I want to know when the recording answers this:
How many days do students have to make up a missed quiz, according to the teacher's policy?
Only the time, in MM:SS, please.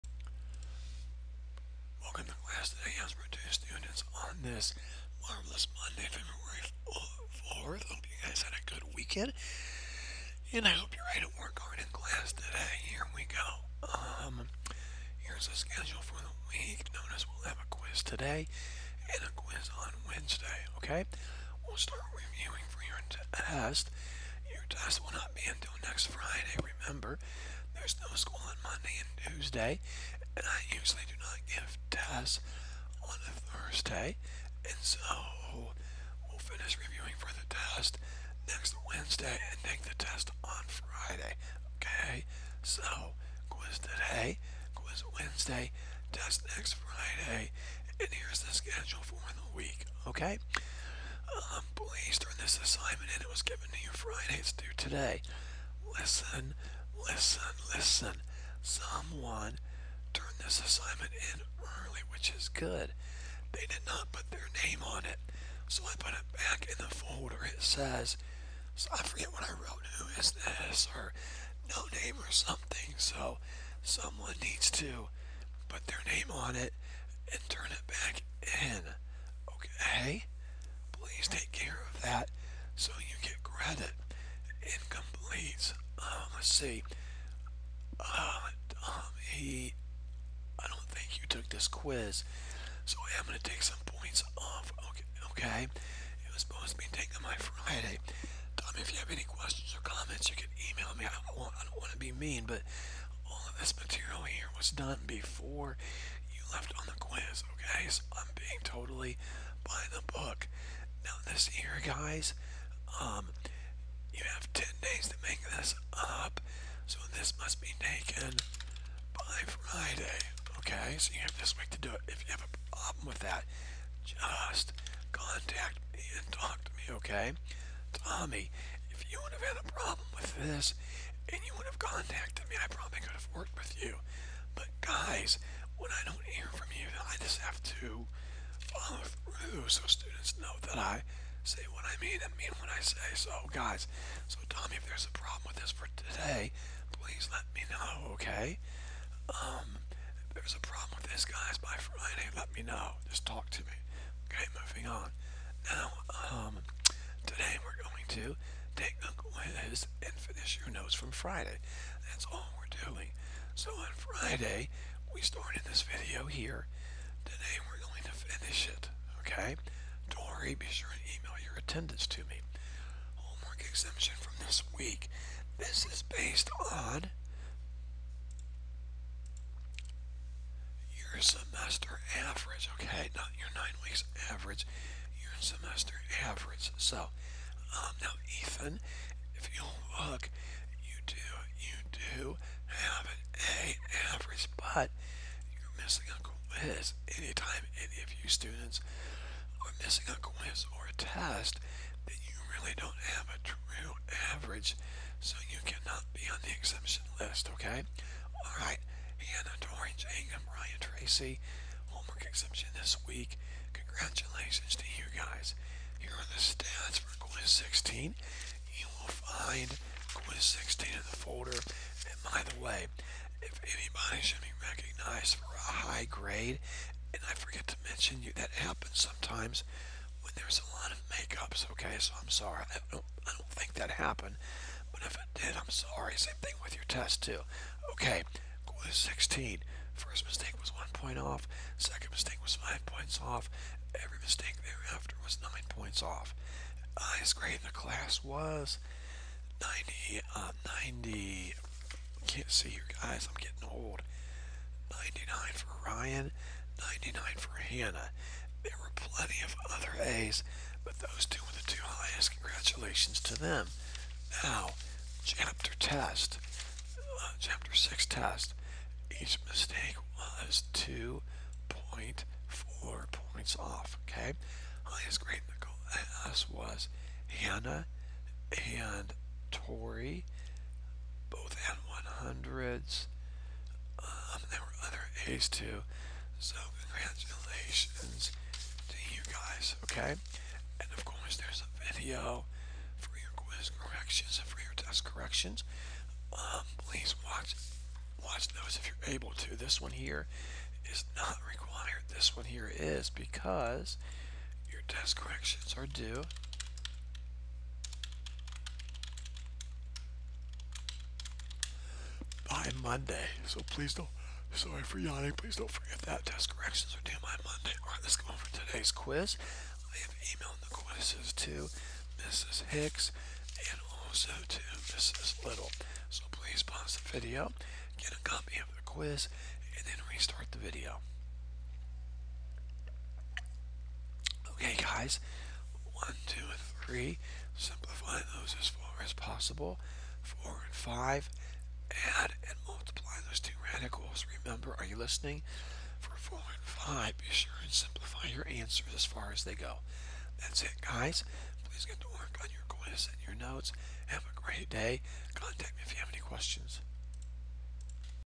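01:54.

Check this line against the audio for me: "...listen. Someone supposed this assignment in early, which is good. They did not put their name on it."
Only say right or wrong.
wrong.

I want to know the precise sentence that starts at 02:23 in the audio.
So, guys, so Tommy, if there's a problem with this for today, please let me know, okay?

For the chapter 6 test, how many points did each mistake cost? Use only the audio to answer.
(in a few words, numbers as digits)
2.4.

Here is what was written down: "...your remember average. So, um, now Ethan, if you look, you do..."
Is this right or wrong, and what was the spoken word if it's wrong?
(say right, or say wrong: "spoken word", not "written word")
wrong: "semester", not "remember".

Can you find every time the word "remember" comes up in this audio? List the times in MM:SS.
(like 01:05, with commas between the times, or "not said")
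00:26, 05:44.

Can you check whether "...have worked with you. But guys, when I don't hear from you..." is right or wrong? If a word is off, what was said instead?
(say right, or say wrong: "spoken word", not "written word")
right.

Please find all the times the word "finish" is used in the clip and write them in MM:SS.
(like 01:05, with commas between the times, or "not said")
00:36, 02:40, 02:48.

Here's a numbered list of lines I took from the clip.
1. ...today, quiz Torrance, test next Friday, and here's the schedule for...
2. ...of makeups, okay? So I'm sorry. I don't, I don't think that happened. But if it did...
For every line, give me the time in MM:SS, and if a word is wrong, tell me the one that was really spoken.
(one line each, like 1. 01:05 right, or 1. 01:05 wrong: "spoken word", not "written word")
1. 00:43 wrong: "Wednesday", not "Torrance"
2. 03:50 right.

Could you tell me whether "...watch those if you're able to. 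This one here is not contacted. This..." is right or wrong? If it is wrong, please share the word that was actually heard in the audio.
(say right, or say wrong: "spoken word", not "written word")
wrong: "required", not "contacted".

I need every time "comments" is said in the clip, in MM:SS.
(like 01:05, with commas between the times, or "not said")
01:39.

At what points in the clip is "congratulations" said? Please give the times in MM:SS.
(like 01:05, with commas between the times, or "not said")
03:33, 04:22, 04:46.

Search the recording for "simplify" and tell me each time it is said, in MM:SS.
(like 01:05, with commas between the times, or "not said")
05:37, 05:47.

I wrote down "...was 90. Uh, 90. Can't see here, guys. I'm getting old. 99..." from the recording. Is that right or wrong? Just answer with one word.
right.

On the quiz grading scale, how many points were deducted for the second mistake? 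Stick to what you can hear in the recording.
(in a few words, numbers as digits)
5.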